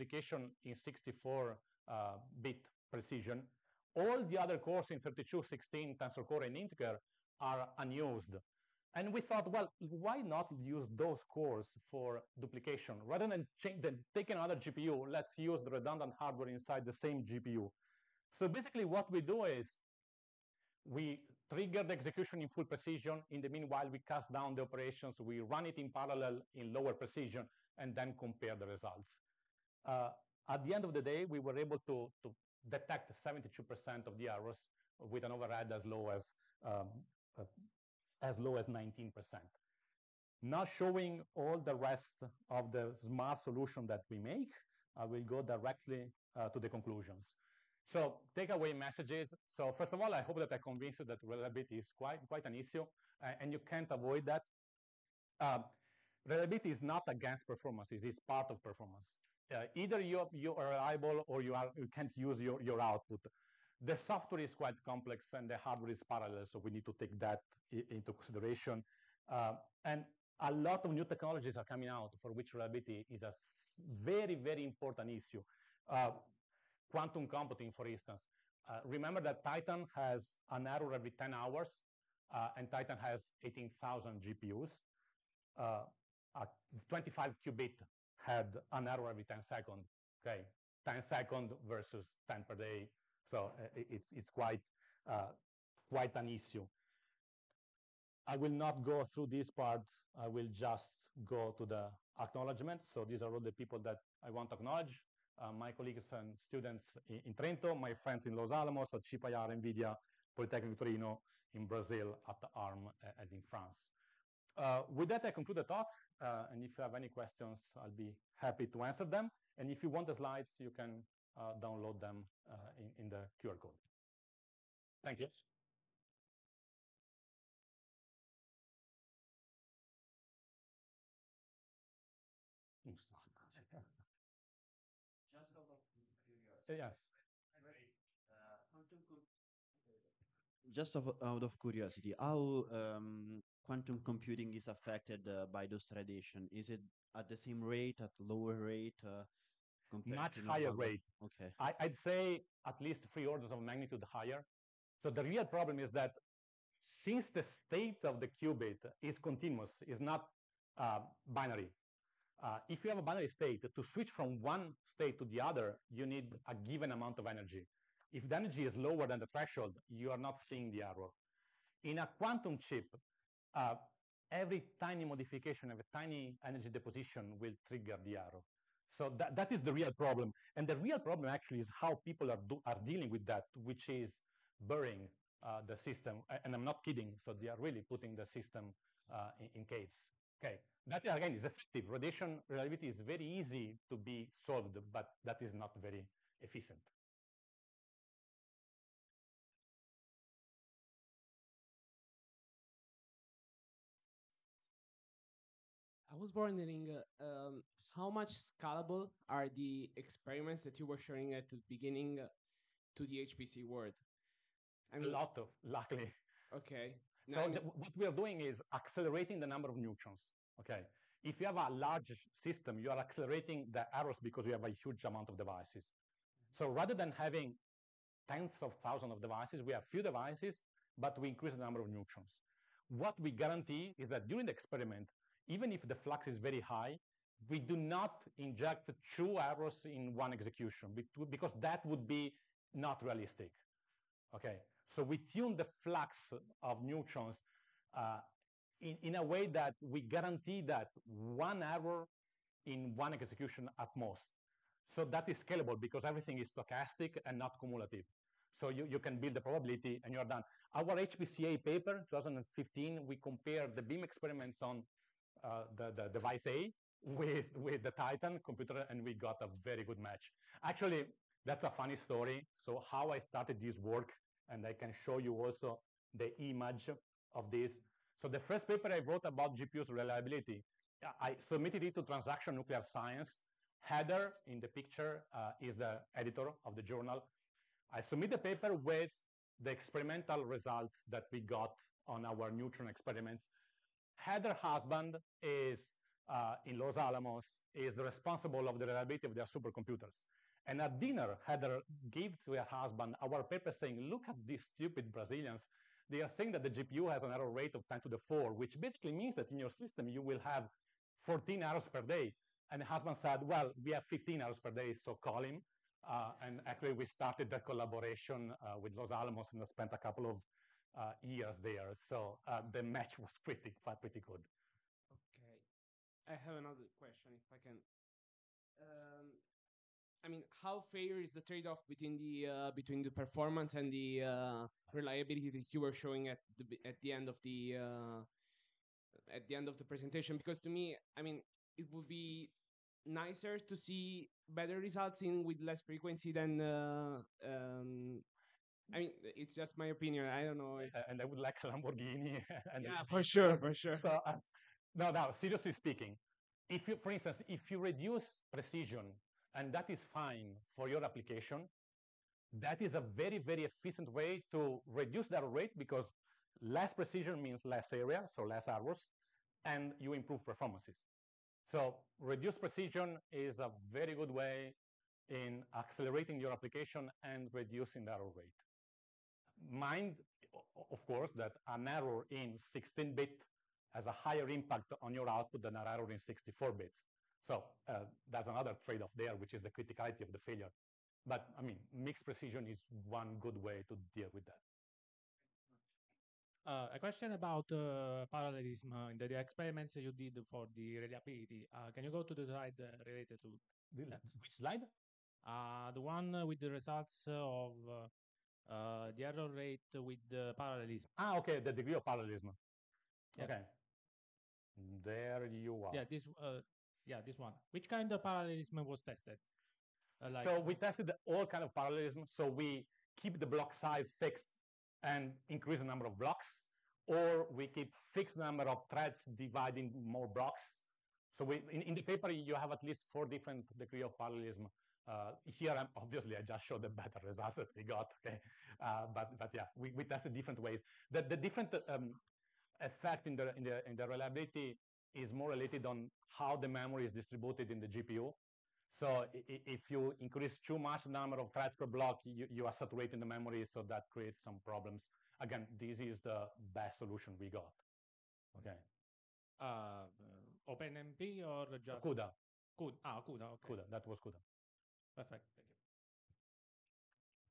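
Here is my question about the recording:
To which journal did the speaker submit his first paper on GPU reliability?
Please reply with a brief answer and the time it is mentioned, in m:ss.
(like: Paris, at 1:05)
Transaction Nuclear Science, at 4:42.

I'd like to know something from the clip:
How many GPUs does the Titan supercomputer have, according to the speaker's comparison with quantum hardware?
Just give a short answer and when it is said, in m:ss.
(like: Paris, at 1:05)
18,000, at 1:23.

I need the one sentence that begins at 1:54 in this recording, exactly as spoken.
Uh, with that, I conclude the talk.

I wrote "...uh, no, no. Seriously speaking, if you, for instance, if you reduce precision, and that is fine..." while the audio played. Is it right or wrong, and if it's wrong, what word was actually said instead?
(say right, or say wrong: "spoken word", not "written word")
right.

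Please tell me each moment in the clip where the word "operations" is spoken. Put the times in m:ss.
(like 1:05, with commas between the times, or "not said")
0:24.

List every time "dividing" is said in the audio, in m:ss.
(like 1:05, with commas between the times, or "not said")
7:09.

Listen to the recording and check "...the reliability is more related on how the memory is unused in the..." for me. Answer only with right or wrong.
wrong.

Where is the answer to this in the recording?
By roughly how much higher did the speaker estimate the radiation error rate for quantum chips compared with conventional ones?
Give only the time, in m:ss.
2:33.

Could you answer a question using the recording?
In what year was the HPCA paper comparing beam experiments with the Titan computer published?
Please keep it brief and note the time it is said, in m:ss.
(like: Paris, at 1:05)
2015, at 4:22.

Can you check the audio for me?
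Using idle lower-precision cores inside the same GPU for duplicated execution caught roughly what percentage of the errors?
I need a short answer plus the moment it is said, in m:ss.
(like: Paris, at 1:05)
72%, at 0:33.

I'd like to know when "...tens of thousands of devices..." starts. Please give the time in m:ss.
3:48.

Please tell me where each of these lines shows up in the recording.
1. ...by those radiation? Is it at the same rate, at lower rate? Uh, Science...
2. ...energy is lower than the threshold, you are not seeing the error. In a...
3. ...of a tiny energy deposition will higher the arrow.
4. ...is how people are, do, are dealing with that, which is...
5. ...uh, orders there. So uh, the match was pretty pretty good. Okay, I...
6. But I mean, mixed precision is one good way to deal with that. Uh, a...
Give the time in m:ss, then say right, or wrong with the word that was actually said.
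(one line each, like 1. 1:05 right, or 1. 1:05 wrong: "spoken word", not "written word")
1. 2:25 wrong: "Much", not "Science"
2. 2:48 right
3. 2:55 wrong: "trigger", not "higher"
4. 3:01 right
5. 5:20 wrong: "years", not "orders"
6. 6:31 right.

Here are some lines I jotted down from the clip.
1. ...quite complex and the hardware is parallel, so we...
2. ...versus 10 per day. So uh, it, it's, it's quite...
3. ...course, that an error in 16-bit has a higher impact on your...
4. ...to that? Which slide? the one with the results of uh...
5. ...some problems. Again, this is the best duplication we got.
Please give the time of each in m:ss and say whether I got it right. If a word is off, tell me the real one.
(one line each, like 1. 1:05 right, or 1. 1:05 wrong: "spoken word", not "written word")
1. 1:04 right
2. 1:31 right
3. 6:21 right
4. 6:43 right
5. 7:34 wrong: "solution", not "duplication".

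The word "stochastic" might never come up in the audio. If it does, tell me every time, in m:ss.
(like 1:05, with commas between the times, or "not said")
4:16.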